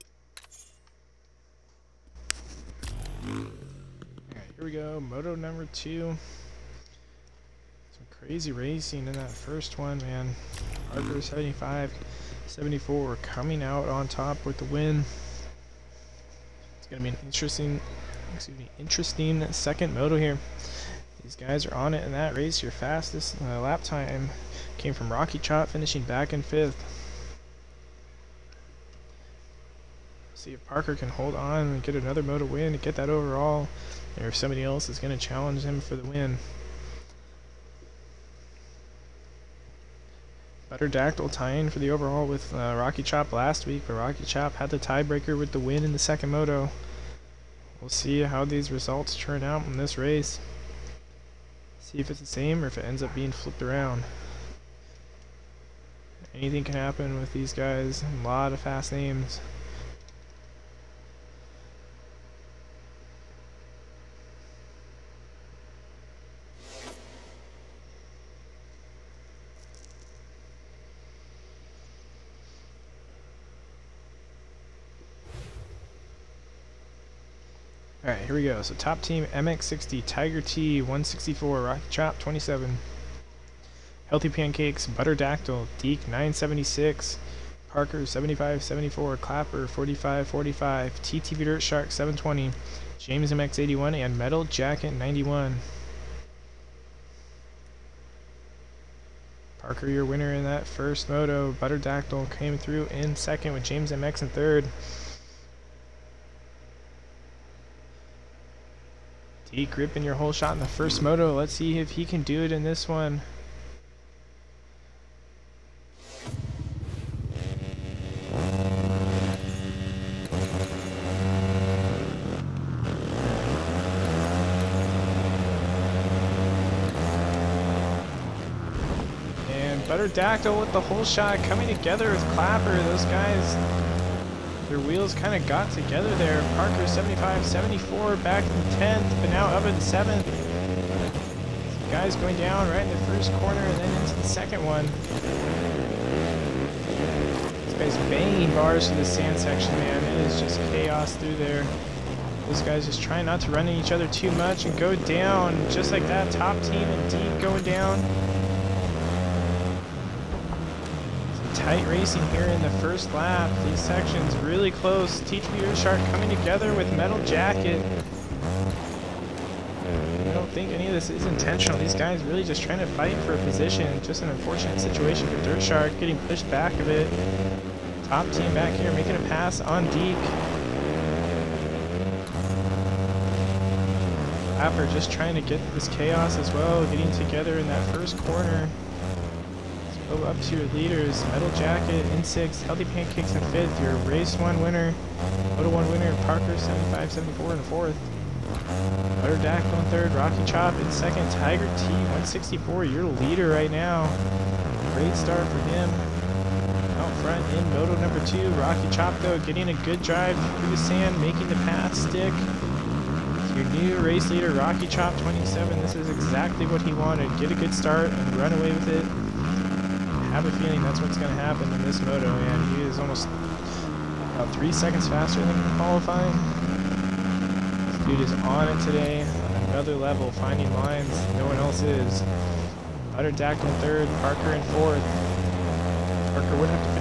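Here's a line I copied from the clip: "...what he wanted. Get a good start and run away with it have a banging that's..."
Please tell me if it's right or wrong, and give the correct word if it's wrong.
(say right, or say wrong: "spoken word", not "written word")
wrong: "feeling", not "banging".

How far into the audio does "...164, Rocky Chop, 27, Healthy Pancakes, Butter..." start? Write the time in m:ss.
1:20.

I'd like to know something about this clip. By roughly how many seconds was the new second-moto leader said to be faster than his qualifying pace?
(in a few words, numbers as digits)
3 seconds.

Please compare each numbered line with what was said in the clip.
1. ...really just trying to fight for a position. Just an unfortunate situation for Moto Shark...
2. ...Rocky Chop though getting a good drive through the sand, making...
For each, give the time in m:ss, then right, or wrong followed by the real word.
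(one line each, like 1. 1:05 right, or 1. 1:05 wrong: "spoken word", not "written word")
1. 2:52 wrong: "Dirt", not "Moto"
2. 3:28 right.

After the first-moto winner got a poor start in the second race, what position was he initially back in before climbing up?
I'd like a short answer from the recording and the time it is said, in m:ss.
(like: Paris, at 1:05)
10th, at 2:18.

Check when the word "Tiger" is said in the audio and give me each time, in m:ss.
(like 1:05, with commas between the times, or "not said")
1:20, 3:21.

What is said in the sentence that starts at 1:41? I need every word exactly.
Butter Dactyl came through in second with James MX in third.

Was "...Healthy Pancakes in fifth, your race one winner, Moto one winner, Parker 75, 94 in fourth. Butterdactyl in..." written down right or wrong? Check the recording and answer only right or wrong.
wrong.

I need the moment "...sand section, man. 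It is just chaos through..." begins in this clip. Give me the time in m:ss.
2:29.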